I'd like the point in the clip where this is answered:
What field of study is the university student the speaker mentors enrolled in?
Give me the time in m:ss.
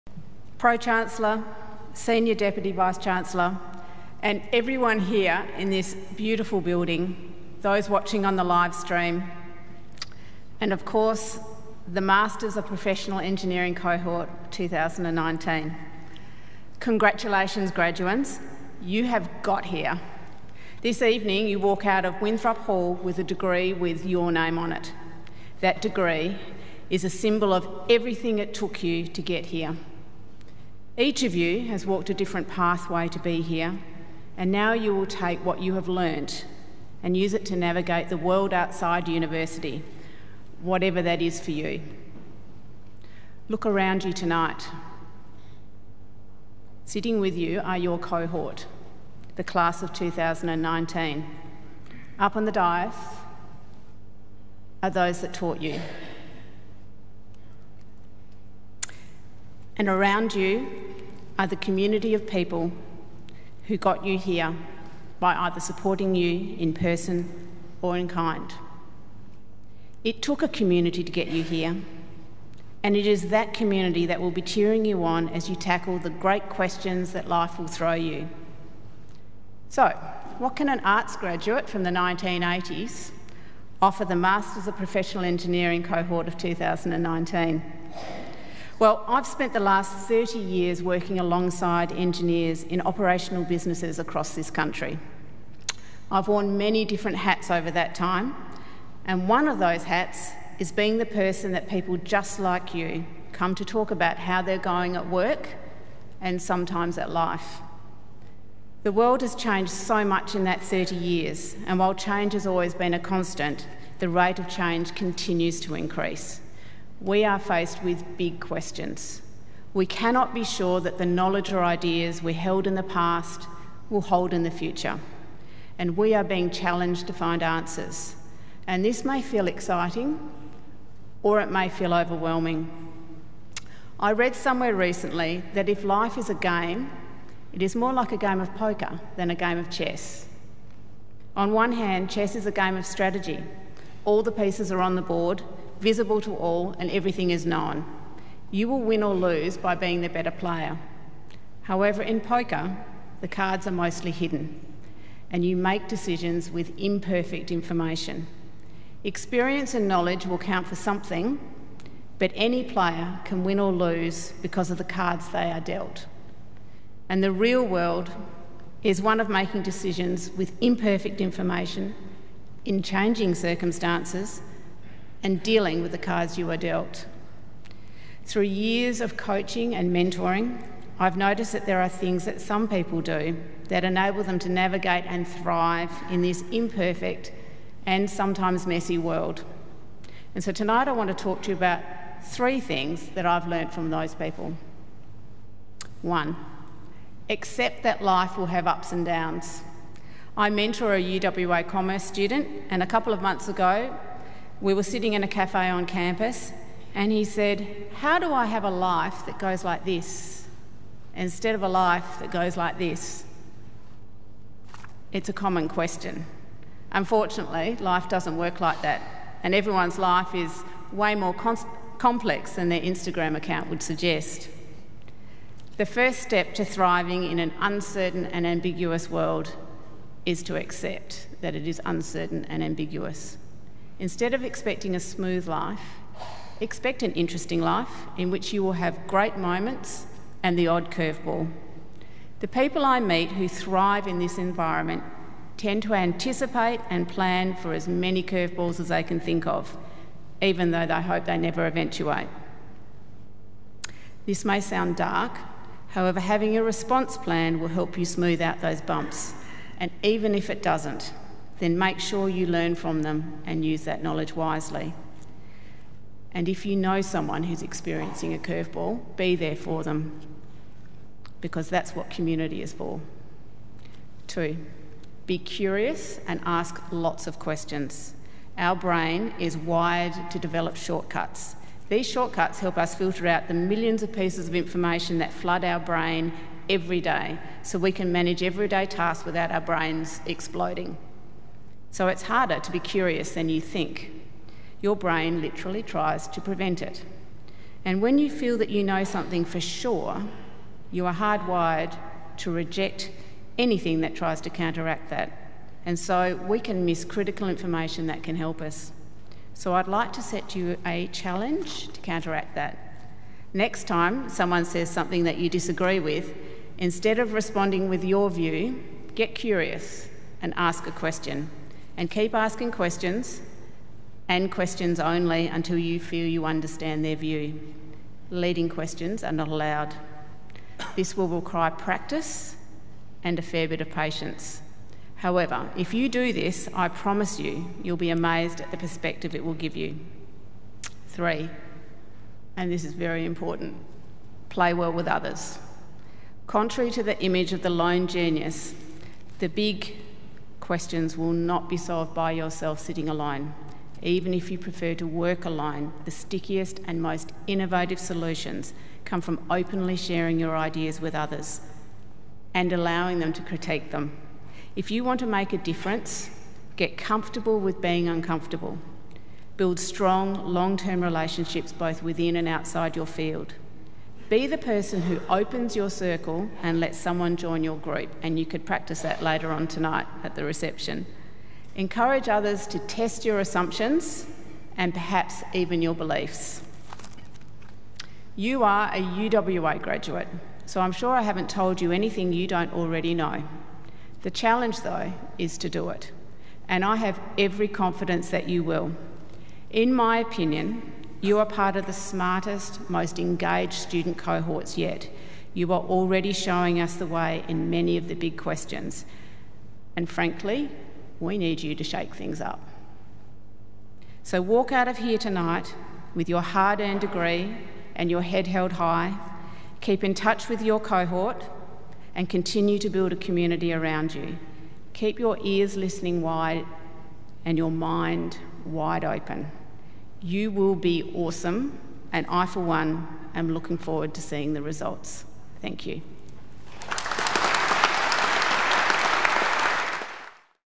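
3:21.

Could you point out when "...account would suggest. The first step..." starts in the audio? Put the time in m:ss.
3:43.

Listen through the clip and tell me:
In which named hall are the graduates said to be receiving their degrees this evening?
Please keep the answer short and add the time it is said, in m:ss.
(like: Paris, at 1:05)
Winthrop Hall, at 0:22.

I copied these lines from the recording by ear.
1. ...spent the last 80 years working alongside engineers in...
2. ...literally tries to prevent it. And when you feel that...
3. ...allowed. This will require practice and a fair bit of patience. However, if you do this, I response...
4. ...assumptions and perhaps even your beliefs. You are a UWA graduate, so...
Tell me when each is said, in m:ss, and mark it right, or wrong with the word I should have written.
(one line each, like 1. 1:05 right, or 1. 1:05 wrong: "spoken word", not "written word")
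1. 1:29 wrong: "30", not "80"
2. 4:55 right
3. 5:29 wrong: "promise", not "response"
4. 6:23 right.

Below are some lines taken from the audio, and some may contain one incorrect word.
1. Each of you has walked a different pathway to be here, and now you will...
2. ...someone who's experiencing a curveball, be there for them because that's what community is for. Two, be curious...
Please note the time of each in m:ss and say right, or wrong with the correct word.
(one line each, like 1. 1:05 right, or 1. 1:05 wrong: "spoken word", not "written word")
1. 0:30 right
2. 4:27 right.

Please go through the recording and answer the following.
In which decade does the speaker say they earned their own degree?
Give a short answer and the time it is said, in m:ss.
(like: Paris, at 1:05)
1980s, at 1:21.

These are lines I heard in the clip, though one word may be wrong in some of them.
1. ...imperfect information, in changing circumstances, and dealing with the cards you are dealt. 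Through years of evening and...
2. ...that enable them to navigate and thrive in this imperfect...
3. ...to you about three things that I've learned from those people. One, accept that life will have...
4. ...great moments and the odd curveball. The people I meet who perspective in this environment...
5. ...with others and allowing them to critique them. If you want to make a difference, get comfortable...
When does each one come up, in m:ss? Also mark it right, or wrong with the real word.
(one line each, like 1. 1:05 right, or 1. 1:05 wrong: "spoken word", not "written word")
1. 2:50 wrong: "coaching", not "evening"
2. 3:03 right
3. 3:11 right
4. 3:59 wrong: "thrive", not "perspective"
5. 6:01 right.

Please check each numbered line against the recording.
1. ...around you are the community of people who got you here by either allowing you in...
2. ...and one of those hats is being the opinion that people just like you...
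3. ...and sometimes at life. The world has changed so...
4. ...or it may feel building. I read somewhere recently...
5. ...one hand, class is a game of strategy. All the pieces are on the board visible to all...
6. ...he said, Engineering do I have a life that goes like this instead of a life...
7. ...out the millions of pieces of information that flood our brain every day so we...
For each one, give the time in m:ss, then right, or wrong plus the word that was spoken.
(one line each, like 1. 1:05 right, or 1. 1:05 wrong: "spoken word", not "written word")
1. 0:59 wrong: "supporting", not "allowing"
2. 1:39 wrong: "person", not "opinion"
3. 1:46 right
4. 2:11 wrong: "overwhelming", not "building"
5. 2:21 wrong: "chess", not "class"
6. 3:27 wrong: "How", not "Engineering"
7. 4:43 right.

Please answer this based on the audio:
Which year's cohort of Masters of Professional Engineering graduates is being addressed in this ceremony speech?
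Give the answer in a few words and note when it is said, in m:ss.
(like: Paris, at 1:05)
2019, at 0:13.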